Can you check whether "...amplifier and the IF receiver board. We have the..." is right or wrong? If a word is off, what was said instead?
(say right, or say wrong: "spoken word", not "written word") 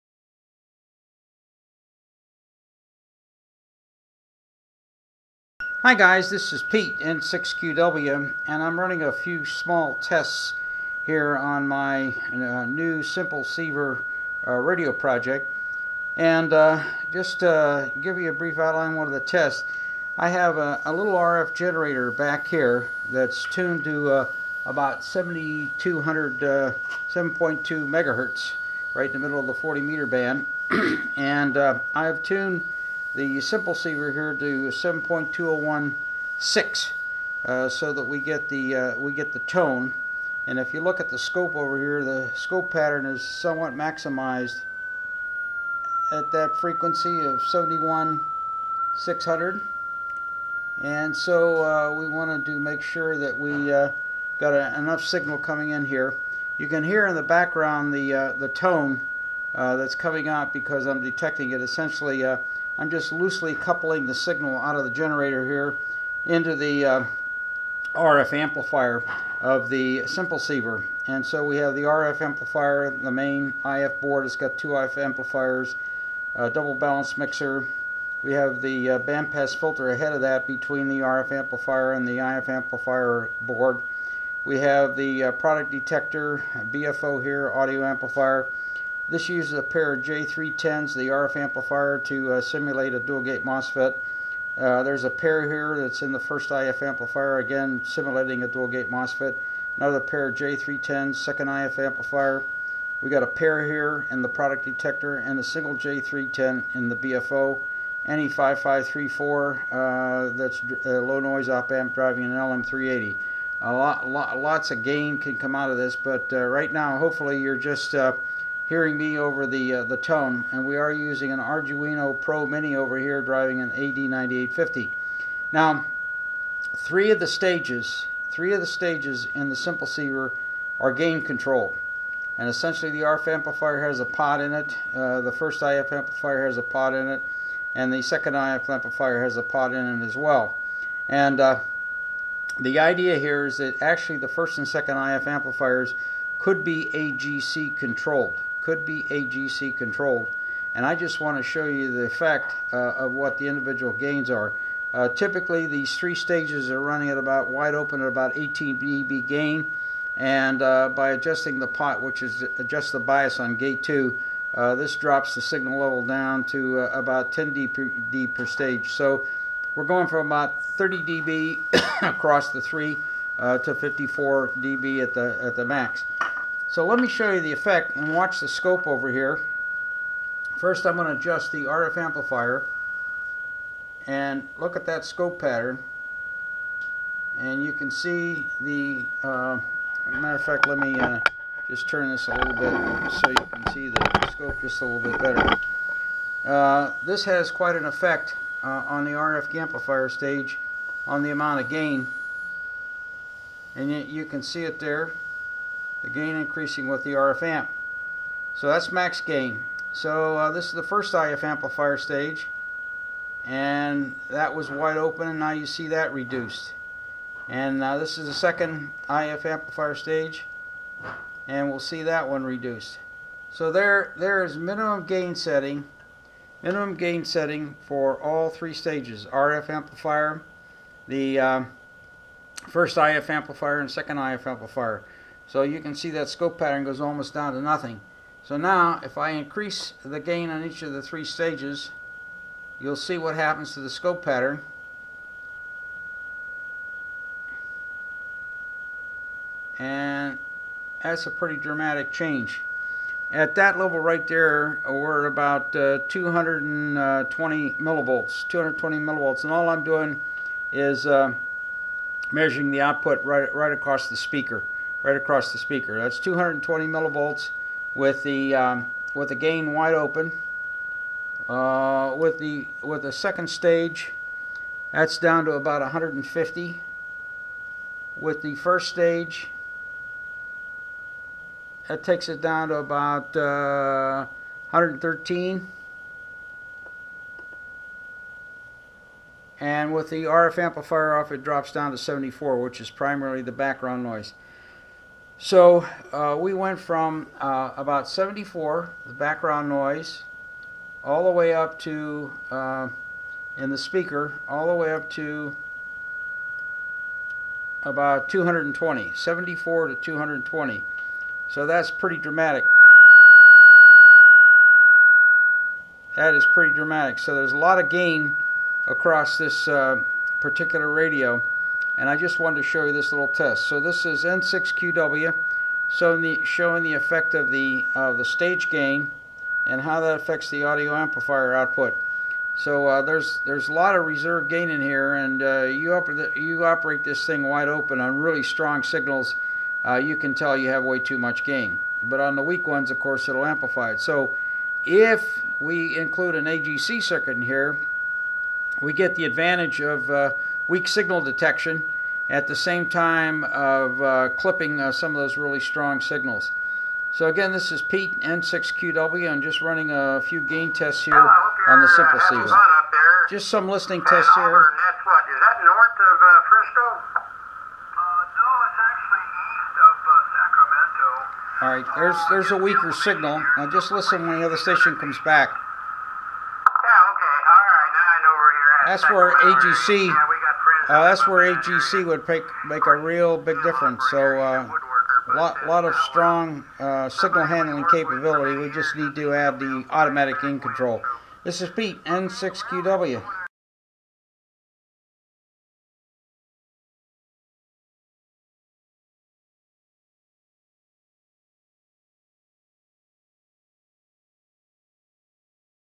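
wrong: "amplifier", not "receiver".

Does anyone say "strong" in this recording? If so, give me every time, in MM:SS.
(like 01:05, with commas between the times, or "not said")
05:38, 05:55, 06:26.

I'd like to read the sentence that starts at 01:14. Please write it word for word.
It's got two IF amplifiers, a double balanced mixer.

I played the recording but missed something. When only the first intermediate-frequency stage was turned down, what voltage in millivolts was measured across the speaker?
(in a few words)
113 millivolts.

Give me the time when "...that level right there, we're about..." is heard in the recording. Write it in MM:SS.
04:13.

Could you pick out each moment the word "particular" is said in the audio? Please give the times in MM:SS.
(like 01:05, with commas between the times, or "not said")
05:20.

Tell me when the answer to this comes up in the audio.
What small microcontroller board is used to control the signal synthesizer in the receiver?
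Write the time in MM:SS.
02:01.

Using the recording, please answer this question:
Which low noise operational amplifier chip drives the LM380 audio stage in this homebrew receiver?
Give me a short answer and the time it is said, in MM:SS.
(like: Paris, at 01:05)
NE5534, at 01:48.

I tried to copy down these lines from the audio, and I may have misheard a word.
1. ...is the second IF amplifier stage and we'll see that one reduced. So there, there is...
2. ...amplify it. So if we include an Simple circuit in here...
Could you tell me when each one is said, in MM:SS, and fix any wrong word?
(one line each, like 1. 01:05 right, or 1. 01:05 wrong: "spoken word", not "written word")
1. 03:38 right
2. 05:43 wrong: "AGC", not "Simple".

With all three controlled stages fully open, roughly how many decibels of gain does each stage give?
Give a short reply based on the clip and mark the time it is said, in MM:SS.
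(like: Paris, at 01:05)
18 dB, at 02:38.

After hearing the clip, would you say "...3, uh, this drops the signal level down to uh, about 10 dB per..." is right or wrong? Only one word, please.
wrong.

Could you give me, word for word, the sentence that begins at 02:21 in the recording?
And uh, the idea here is that actually the first and second IF amplifiers could be AGC controlled could be AGC controlled.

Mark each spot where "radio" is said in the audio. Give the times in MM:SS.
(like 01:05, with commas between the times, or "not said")
00:14, 05:20.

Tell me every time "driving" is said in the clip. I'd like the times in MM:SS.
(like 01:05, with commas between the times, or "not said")
01:51, 02:03.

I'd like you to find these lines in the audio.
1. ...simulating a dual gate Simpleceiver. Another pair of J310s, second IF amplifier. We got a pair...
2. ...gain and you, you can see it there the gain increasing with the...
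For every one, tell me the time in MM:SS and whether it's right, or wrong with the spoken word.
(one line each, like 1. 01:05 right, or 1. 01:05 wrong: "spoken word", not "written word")
1. 01:37 wrong: "MOSFET", not "Simpleceiver"
2. 03:21 right.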